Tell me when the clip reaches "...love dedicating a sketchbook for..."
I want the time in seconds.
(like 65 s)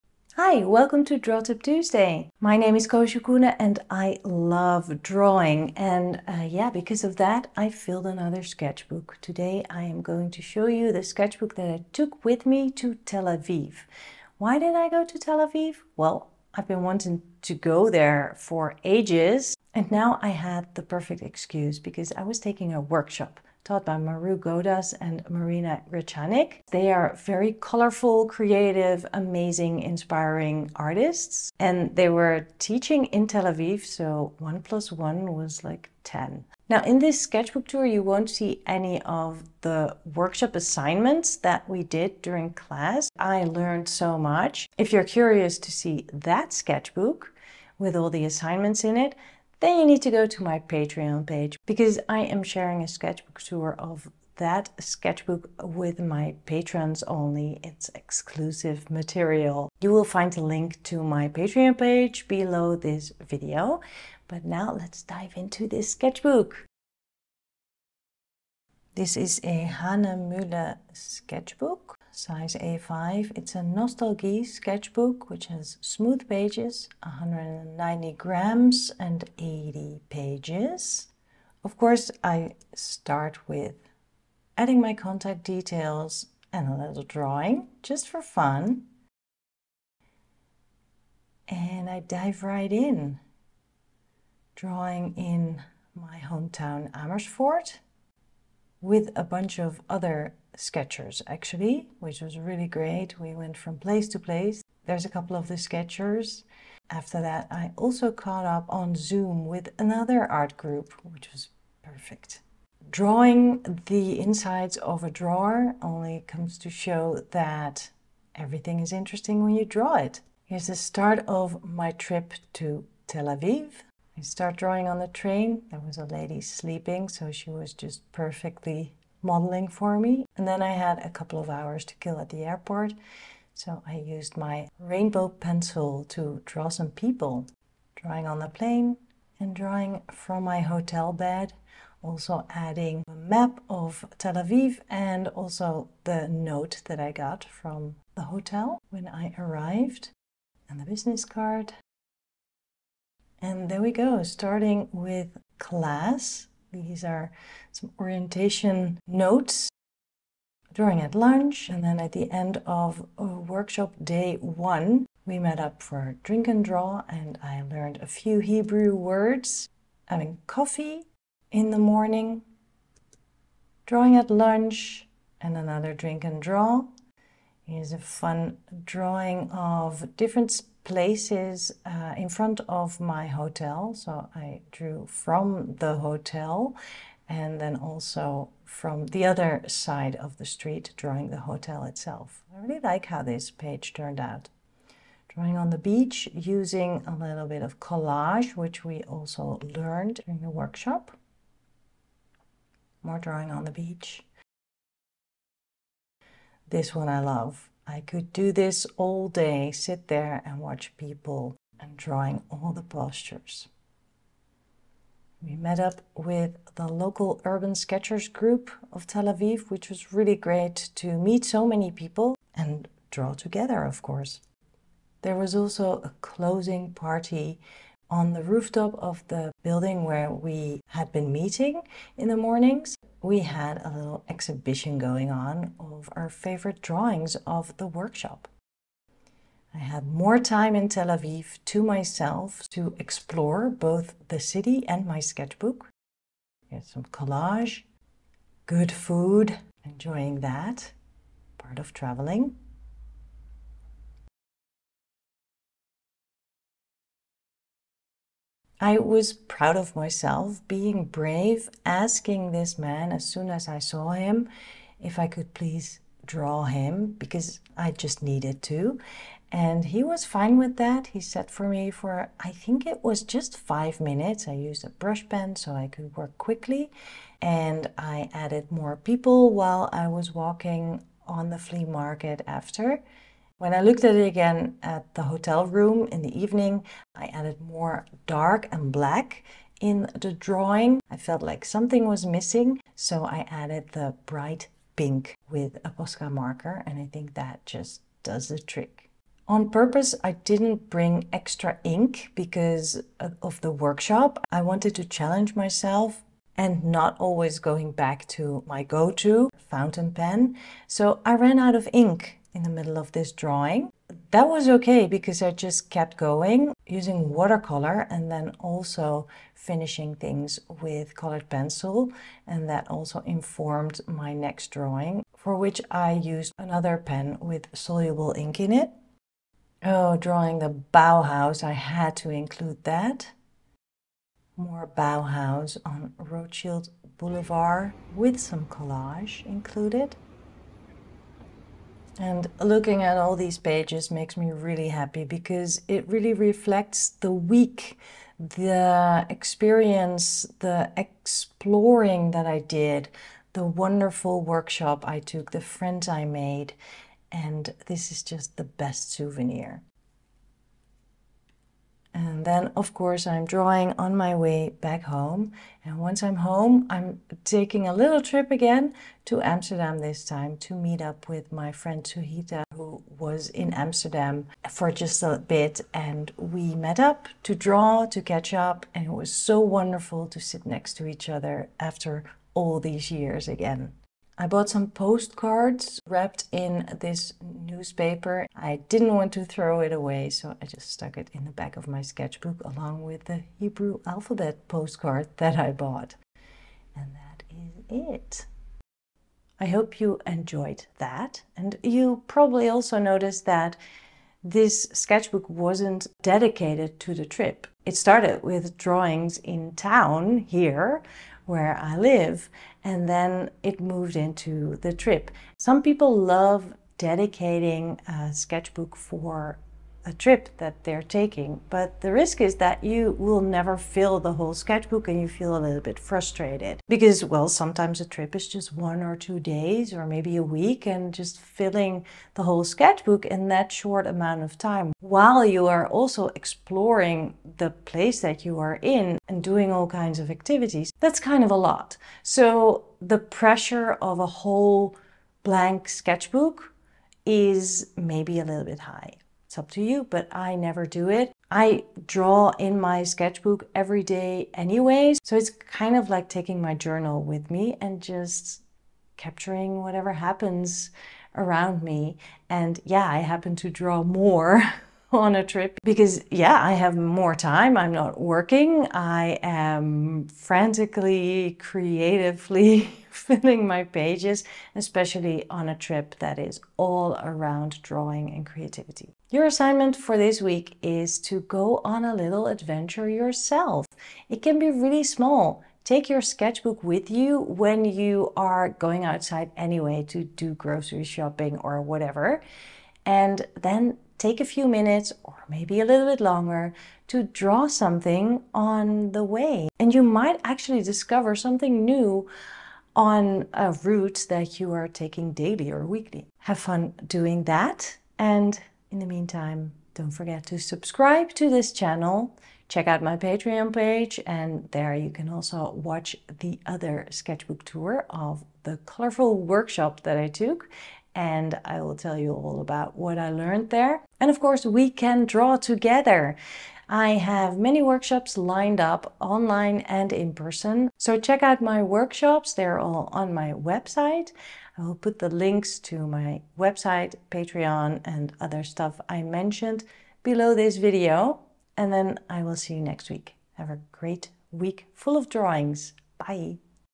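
416 s.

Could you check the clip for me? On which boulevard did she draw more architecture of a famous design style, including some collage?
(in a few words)
Rothschild Boulevard.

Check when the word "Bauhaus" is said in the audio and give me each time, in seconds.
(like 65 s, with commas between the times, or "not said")
330 s, 334 s.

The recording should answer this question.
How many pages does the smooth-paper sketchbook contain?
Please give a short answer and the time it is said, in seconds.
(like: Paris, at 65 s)
80, at 79 s.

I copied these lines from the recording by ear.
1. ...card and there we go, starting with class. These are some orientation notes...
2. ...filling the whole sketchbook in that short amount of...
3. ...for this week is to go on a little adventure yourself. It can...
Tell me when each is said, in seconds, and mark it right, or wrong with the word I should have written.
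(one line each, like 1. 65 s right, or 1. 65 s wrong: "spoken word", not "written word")
1. 151 s right
2. 431 s right
3. 479 s right.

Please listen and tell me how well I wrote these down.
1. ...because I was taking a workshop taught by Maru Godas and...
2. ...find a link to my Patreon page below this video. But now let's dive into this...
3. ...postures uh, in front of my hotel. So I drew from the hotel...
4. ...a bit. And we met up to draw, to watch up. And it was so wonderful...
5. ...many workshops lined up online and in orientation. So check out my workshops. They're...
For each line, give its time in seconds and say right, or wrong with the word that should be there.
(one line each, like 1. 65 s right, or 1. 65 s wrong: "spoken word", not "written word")
1. 21 s right
2. 60 s right
3. 180 s wrong: "places", not "postures"
4. 375 s wrong: "catch", not "watch"
5. 527 s wrong: "person", not "orientation".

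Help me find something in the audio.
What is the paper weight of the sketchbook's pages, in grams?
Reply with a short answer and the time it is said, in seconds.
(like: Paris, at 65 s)
190, at 77 s.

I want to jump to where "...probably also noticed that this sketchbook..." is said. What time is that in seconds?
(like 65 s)
402 s.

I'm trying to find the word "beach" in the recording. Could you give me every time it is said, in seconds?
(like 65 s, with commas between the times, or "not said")
195 s, 203 s.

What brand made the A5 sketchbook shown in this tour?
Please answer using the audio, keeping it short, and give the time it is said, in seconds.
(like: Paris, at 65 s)
Hahnemühle, at 69 s.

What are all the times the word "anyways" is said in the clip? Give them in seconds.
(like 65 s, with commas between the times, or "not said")
454 s, 489 s.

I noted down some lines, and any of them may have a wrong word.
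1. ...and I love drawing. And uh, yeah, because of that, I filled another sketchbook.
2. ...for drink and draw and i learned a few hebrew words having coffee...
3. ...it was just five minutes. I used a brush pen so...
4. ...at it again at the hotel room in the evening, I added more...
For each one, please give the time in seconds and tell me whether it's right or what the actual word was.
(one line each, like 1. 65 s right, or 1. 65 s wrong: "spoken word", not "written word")
1. 3 s right
2. 165 s right
3. 272 s right
4. 284 s right.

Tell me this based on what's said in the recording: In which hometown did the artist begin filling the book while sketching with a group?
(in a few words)
Amersfoort.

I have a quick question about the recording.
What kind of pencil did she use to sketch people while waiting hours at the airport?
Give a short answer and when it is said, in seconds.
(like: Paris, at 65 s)
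rainbow pencil, at 134 s.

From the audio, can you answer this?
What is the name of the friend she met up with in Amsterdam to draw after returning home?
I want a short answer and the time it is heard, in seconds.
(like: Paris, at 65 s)
Suhita, at 372 s.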